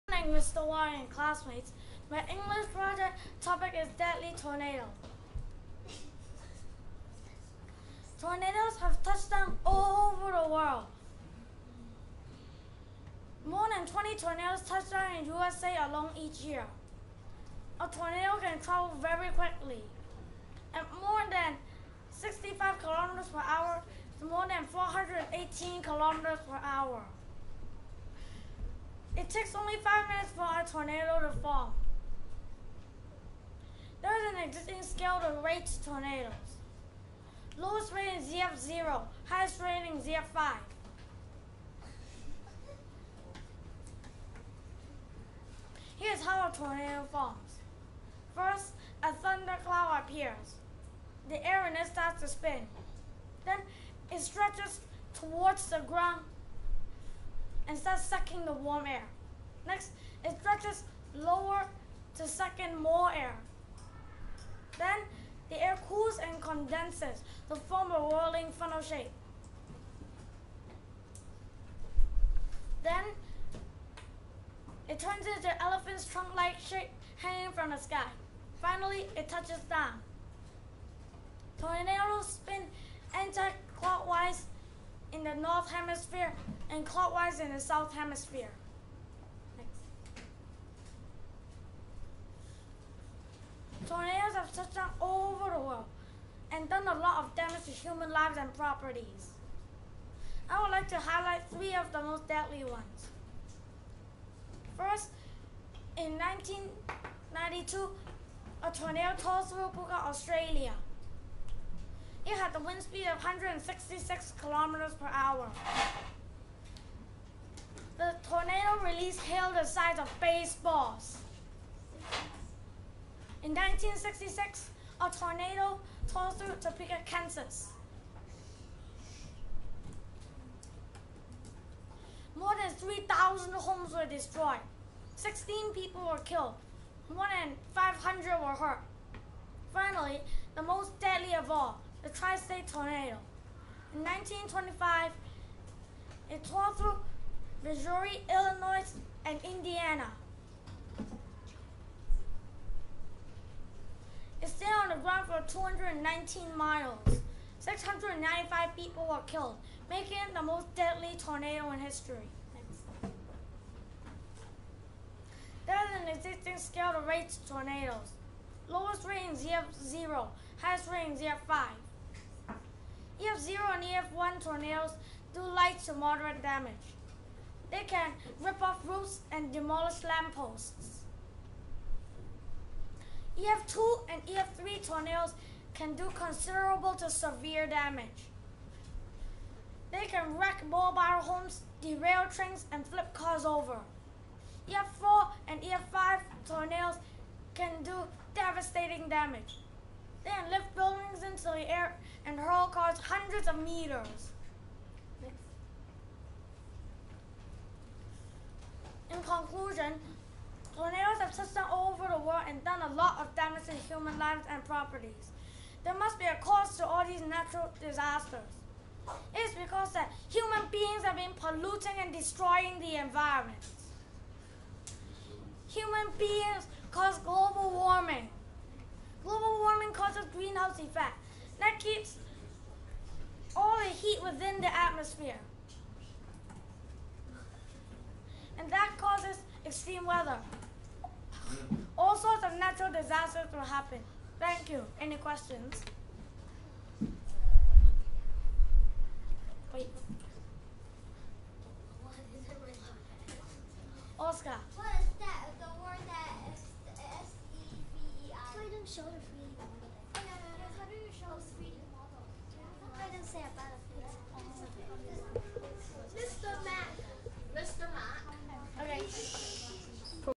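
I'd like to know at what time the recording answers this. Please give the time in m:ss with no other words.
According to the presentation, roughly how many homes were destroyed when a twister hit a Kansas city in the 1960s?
2:12.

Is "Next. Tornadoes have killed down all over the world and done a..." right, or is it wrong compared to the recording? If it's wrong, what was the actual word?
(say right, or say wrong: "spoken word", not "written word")
wrong: "touched", not "killed".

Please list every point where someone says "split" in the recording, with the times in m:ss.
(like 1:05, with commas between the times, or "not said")
not said.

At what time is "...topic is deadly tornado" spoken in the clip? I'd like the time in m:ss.
0:03.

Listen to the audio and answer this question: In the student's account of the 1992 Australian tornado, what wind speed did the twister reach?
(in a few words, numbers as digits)
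166 km/h.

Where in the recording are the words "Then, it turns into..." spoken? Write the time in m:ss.
1:12.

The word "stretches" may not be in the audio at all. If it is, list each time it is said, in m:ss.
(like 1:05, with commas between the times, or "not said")
0:54, 1:00.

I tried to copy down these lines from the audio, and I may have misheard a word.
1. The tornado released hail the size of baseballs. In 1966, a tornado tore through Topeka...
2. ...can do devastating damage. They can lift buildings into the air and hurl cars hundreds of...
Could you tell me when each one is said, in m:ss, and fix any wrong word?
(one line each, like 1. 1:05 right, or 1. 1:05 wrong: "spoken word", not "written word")
1. 1:58 right
2. 3:17 right.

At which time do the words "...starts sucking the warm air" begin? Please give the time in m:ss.
0:57.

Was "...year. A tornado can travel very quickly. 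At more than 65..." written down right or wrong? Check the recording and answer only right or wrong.
right.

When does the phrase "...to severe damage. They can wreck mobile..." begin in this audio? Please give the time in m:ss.
3:06.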